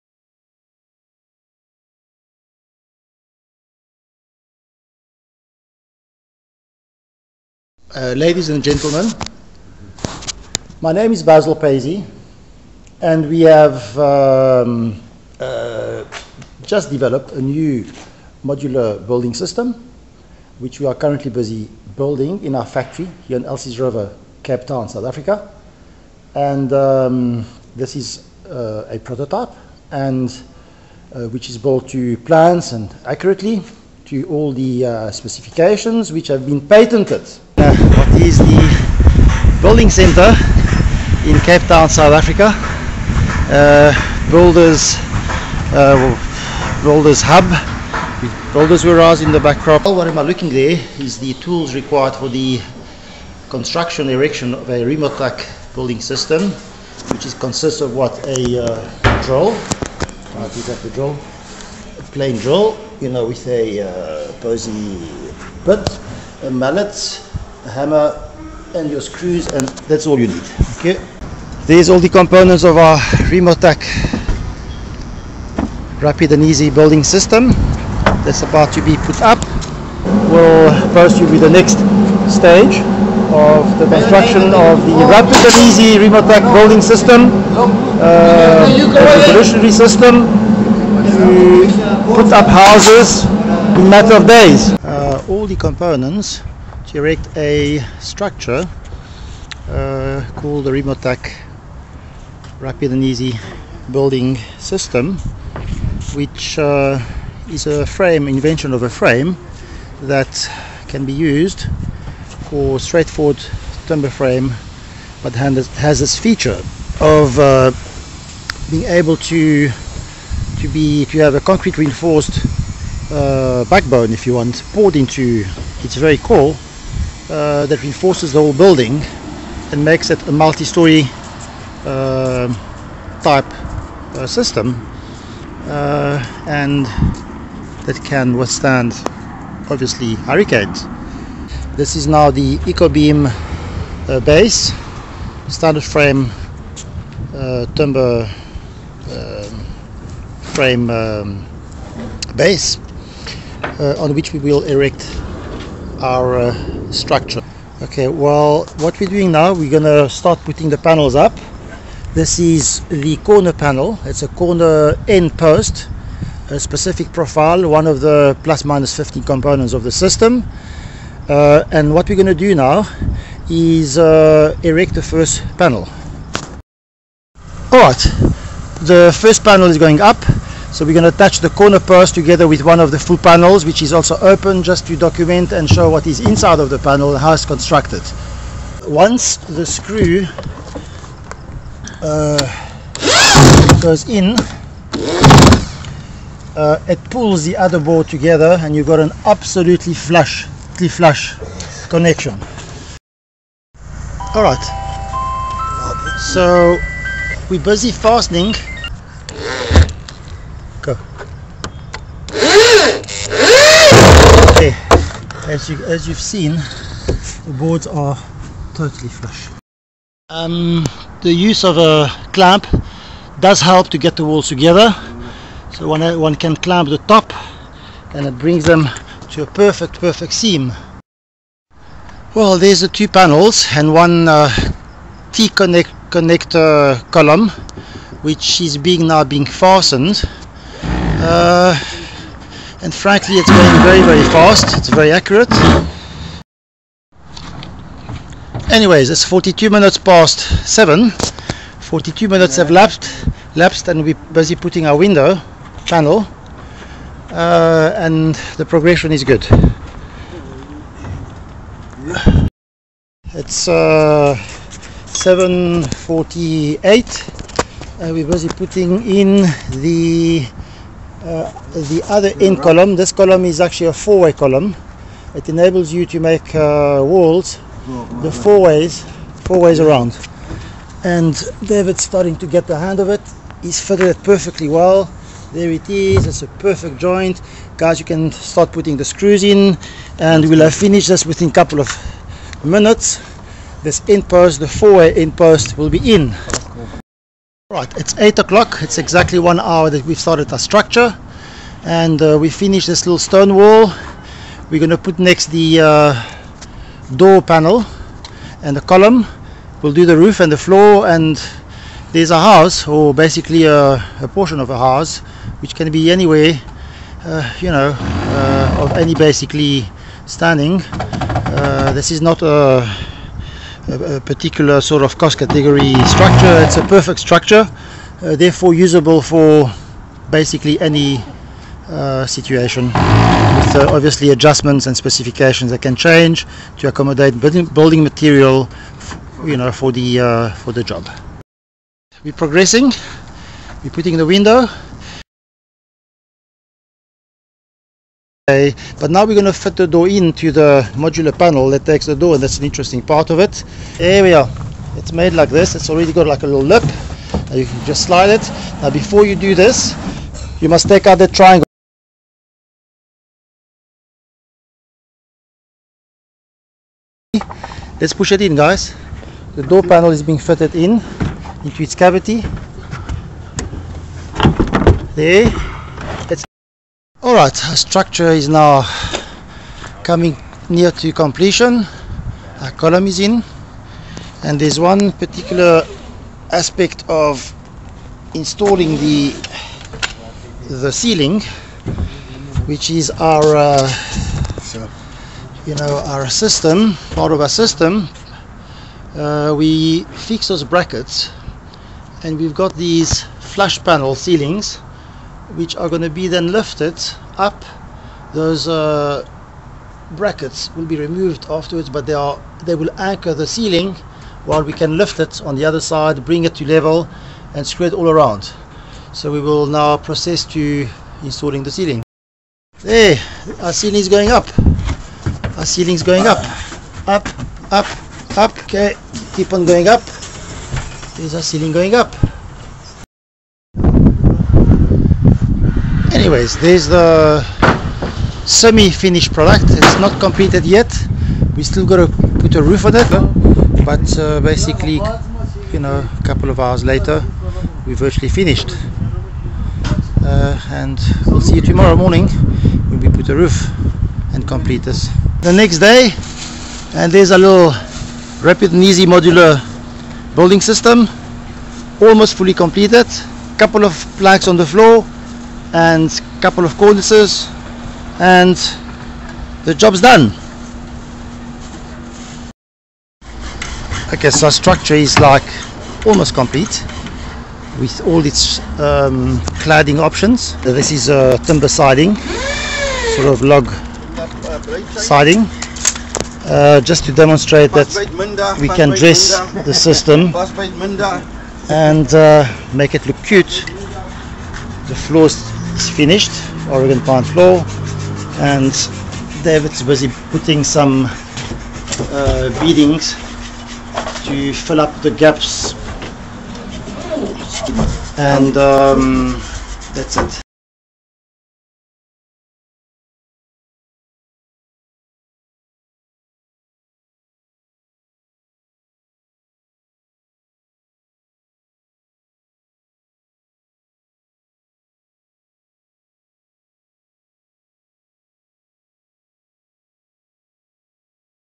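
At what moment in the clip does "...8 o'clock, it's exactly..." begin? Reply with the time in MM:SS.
04:58.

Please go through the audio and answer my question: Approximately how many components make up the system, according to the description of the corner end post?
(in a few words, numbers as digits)
15.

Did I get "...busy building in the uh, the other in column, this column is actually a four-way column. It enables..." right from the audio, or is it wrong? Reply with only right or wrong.
wrong.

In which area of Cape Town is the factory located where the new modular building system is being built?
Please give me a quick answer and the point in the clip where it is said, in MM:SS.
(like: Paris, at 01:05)
Elsie's River, at 00:23.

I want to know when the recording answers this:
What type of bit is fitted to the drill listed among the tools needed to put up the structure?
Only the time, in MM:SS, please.
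01:04.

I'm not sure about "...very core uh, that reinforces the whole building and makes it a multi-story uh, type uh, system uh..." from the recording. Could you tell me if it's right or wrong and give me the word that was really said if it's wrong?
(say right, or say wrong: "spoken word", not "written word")
right.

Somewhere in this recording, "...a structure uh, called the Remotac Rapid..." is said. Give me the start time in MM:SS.
01:37.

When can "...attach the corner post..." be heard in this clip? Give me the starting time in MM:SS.
03:01.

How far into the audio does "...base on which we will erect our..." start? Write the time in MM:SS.
02:32.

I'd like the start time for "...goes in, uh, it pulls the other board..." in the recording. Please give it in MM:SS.
03:13.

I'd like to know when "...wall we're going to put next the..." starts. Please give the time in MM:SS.
05:03.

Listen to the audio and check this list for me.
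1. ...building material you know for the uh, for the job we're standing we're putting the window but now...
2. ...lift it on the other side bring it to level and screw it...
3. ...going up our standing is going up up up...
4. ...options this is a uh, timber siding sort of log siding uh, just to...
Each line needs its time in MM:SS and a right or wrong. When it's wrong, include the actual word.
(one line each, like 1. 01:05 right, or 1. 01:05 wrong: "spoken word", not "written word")
1. 05:37 wrong: "progressing", not "standing"
2. 06:54 right
3. 07:04 wrong: "ceiling", not "standing"
4. 07:59 right.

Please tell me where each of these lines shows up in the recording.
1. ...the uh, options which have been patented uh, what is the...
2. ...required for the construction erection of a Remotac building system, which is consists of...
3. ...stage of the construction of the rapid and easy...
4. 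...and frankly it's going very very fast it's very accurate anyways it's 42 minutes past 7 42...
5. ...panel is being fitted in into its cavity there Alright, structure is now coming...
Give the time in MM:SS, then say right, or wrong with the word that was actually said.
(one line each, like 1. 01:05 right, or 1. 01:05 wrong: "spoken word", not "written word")
1. 00:34 wrong: "specifications", not "options"
2. 00:51 right
3. 01:22 right
4. 04:02 right
5. 06:09 right.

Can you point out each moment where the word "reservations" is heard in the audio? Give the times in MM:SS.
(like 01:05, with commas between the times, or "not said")
not said.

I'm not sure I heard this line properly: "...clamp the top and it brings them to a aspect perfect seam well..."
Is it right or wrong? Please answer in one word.
wrong.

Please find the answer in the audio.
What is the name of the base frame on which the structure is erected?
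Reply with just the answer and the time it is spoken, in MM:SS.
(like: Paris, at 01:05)
EcoBeam, at 02:22.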